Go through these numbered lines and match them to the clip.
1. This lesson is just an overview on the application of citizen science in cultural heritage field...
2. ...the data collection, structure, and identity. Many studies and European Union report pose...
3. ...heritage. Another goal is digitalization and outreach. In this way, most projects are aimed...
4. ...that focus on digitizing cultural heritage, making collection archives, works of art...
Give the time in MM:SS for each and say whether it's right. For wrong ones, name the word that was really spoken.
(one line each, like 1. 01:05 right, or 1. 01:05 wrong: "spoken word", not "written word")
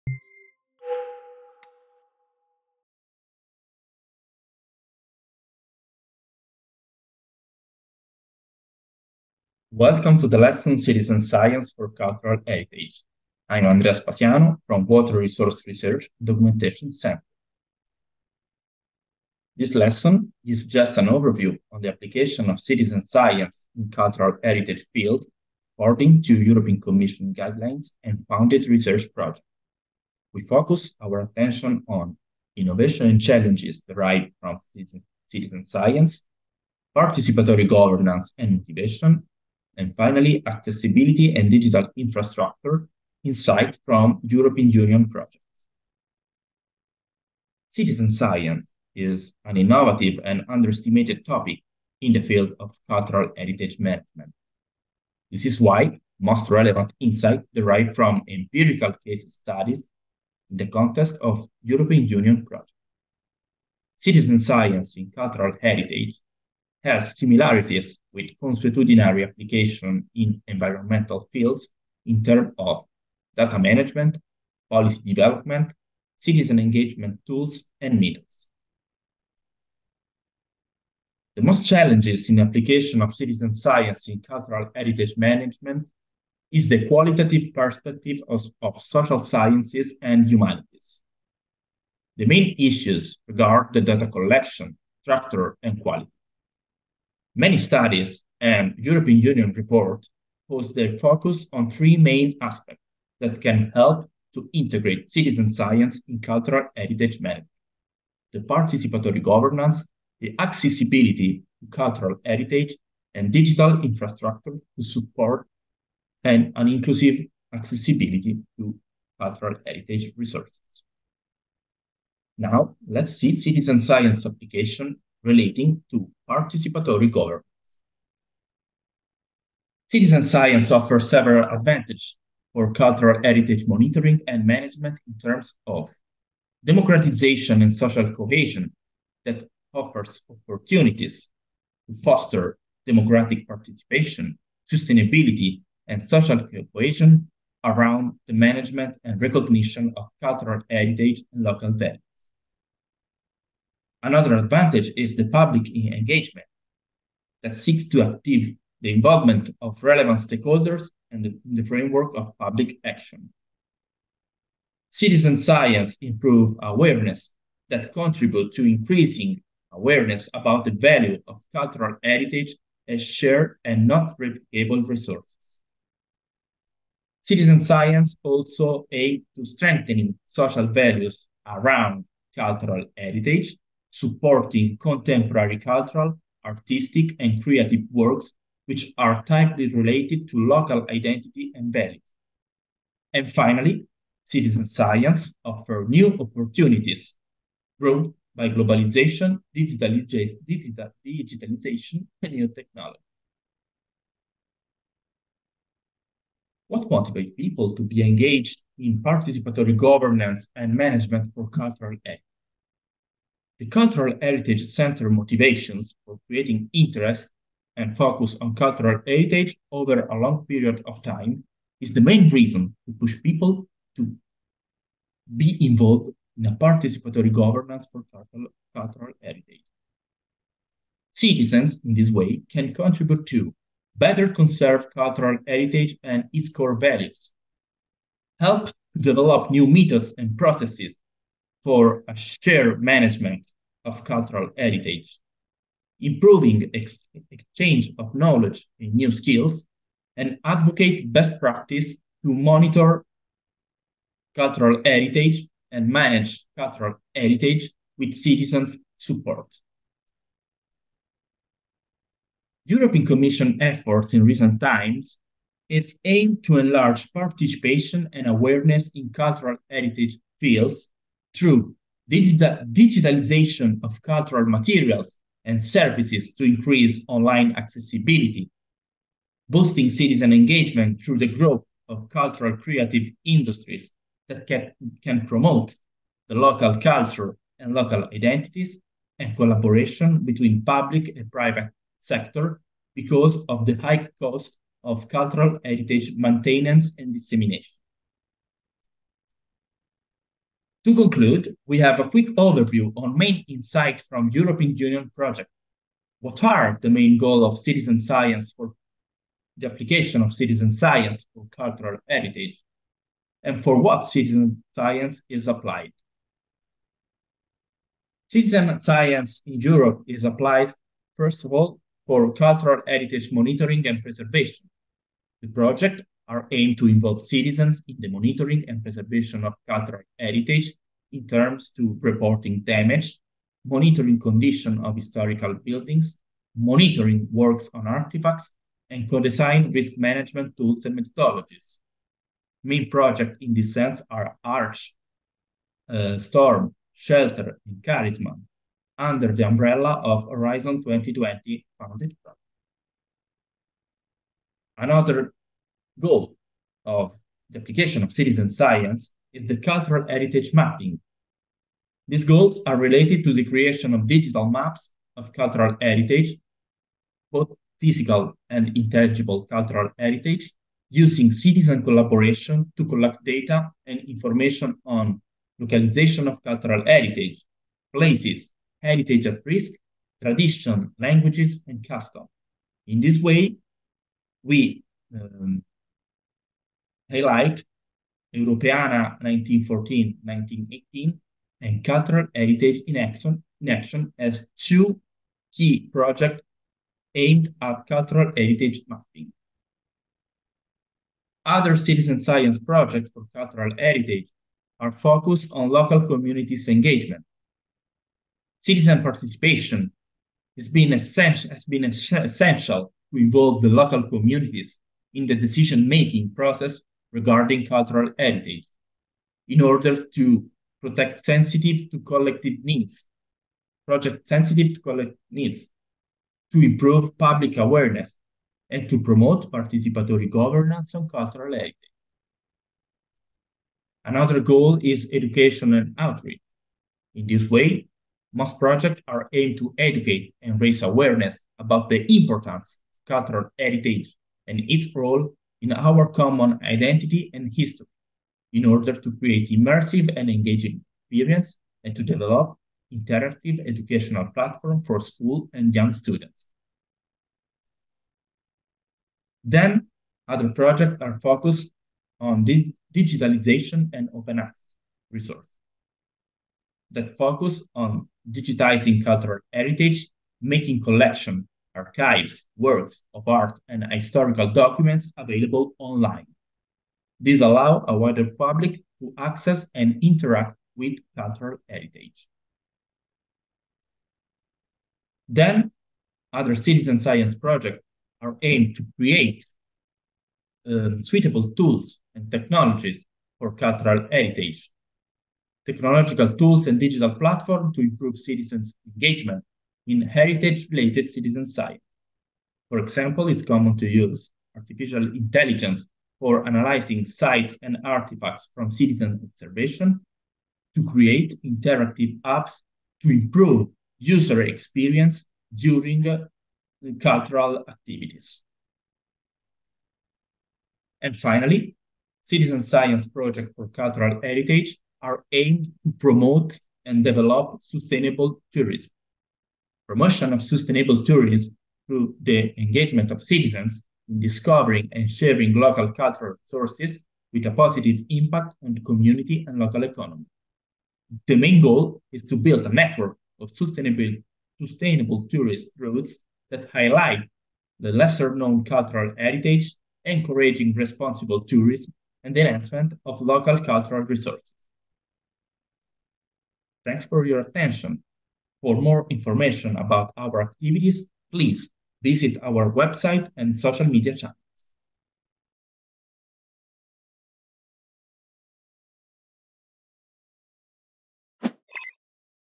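1. 00:19 right
2. 01:33 wrong: "quality", not "identity"
3. 07:11 wrong: "education", not "digitalization"
4. 07:46 right.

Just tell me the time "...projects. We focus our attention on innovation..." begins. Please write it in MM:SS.
00:29.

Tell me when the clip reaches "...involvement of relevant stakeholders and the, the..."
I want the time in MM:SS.
02:38.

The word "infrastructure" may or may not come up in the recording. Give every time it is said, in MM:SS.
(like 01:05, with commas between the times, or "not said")
00:41, 01:53.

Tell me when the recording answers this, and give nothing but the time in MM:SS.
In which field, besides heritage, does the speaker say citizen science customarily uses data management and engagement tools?
01:10.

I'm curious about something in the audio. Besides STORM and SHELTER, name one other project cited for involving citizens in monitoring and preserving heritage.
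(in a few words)
CHARISMA.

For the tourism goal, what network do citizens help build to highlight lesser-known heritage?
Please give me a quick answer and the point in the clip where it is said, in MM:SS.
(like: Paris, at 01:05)
Sustainable tourist routes, at 09:04.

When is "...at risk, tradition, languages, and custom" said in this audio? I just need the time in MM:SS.
06:19.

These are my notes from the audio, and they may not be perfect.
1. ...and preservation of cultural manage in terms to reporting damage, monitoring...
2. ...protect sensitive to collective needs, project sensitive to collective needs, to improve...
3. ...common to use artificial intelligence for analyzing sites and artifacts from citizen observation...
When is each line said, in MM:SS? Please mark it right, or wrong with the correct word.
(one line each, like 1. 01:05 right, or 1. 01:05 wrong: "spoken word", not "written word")
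1. 05:28 wrong: "heritage", not "manage"
2. 07:00 right
3. 08:23 right.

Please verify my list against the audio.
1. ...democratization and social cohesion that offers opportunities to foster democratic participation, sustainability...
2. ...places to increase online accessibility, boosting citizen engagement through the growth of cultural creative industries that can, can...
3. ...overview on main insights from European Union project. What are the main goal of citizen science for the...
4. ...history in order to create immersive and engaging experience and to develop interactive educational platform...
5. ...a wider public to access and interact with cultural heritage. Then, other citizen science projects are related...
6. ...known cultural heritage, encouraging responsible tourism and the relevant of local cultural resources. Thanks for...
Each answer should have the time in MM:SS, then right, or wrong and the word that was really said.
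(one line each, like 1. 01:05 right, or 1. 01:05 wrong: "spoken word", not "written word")
1. 02:16 right
2. 04:35 wrong: "services", not "places"
3. 05:02 right
4. 07:27 right
5. 07:57 wrong: "aimed", not "related"
6. 09:08 wrong: "enhancement", not "relevant".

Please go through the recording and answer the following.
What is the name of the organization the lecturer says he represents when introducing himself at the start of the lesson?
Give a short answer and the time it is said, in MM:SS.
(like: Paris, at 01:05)
Water Resource Research Documentation Center, at 00:14.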